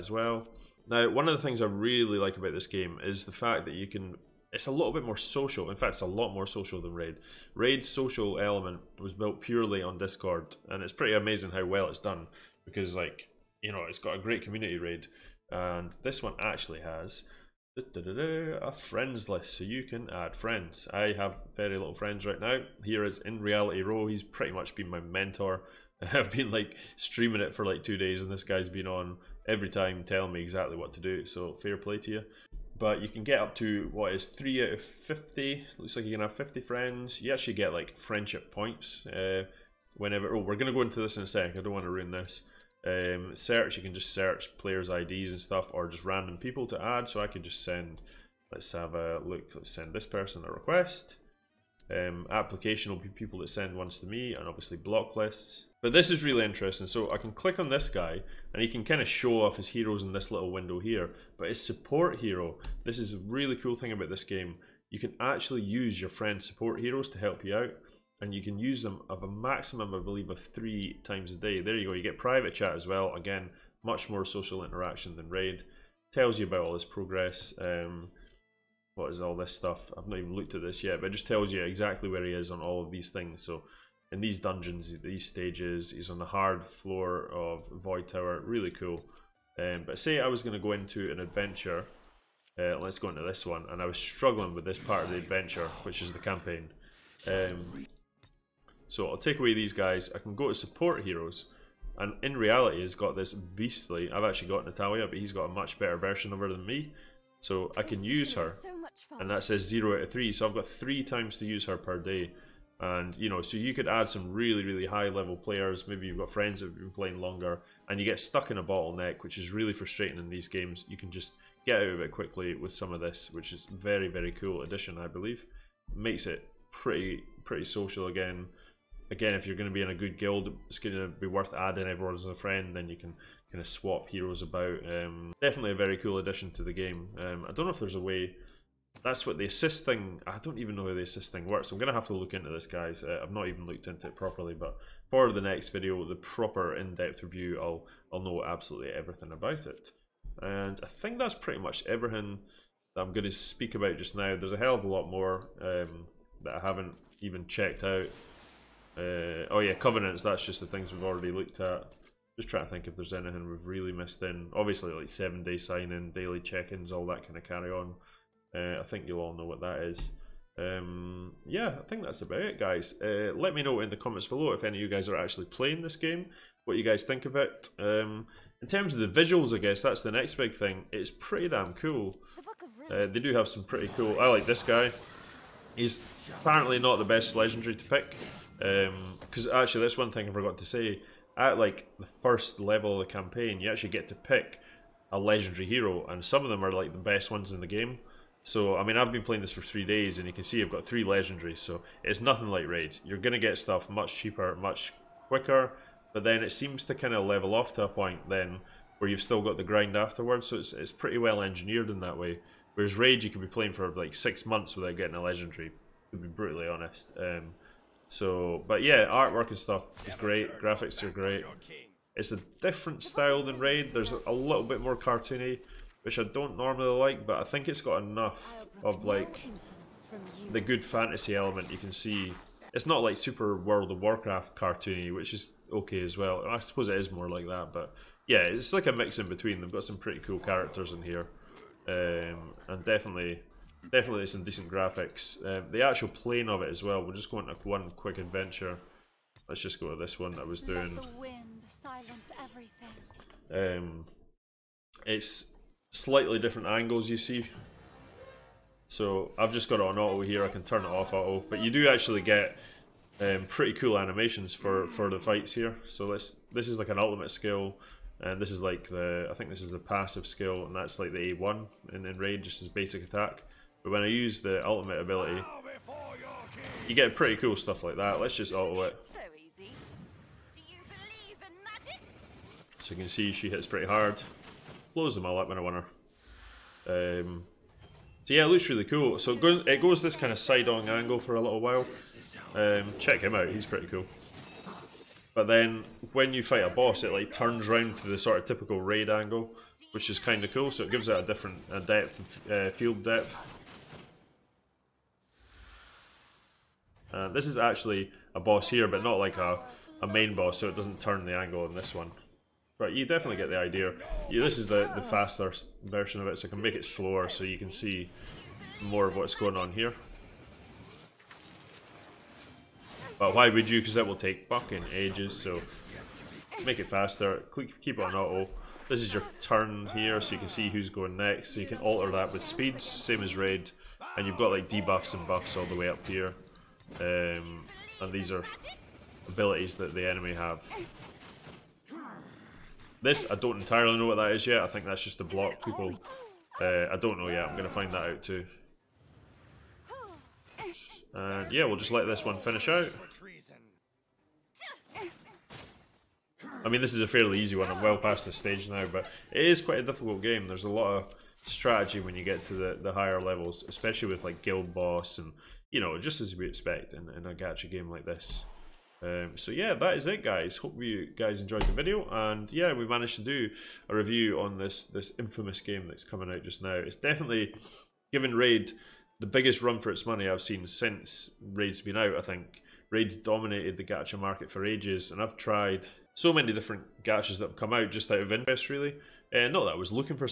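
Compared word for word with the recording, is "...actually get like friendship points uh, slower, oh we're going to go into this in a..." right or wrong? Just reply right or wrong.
wrong.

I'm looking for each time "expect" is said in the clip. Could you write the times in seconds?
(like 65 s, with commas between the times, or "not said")
366 s.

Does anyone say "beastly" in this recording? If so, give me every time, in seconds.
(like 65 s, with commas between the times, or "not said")
103 s.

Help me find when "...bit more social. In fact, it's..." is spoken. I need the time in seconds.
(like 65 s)
4 s.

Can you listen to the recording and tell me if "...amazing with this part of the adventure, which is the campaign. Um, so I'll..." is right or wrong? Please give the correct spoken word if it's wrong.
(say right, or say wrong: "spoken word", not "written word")
wrong: "struggling", not "amazing".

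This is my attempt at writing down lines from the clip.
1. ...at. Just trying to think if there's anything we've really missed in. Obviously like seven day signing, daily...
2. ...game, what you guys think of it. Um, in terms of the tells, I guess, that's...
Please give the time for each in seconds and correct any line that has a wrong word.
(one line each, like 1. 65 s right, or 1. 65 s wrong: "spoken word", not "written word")
1. 161 s right
2. 175 s wrong: "visuals", not "tells".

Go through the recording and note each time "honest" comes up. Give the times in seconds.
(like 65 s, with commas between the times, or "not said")
216 s.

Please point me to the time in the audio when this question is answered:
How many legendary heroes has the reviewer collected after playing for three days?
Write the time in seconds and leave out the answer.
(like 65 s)
200 s.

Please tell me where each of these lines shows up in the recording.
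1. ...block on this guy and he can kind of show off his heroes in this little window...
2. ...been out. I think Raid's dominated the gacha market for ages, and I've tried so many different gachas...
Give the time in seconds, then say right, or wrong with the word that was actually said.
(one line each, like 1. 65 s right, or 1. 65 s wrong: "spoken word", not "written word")
1. 57 s wrong: "click", not "block"
2. 381 s right.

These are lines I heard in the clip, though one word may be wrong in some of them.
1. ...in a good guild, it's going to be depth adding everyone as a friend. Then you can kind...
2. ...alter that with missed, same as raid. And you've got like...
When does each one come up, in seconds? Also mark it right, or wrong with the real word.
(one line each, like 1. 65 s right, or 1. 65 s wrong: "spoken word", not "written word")
1. 129 s wrong: "worth", not "depth"
2. 331 s wrong: "speed", not "missed".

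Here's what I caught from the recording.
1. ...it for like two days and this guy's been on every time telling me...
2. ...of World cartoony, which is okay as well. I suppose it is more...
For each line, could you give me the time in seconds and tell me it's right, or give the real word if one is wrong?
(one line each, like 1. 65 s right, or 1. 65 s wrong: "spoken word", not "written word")
1. 27 s right
2. 233 s wrong: "Warcraft", not "World".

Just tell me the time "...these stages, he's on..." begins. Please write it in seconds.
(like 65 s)
85 s.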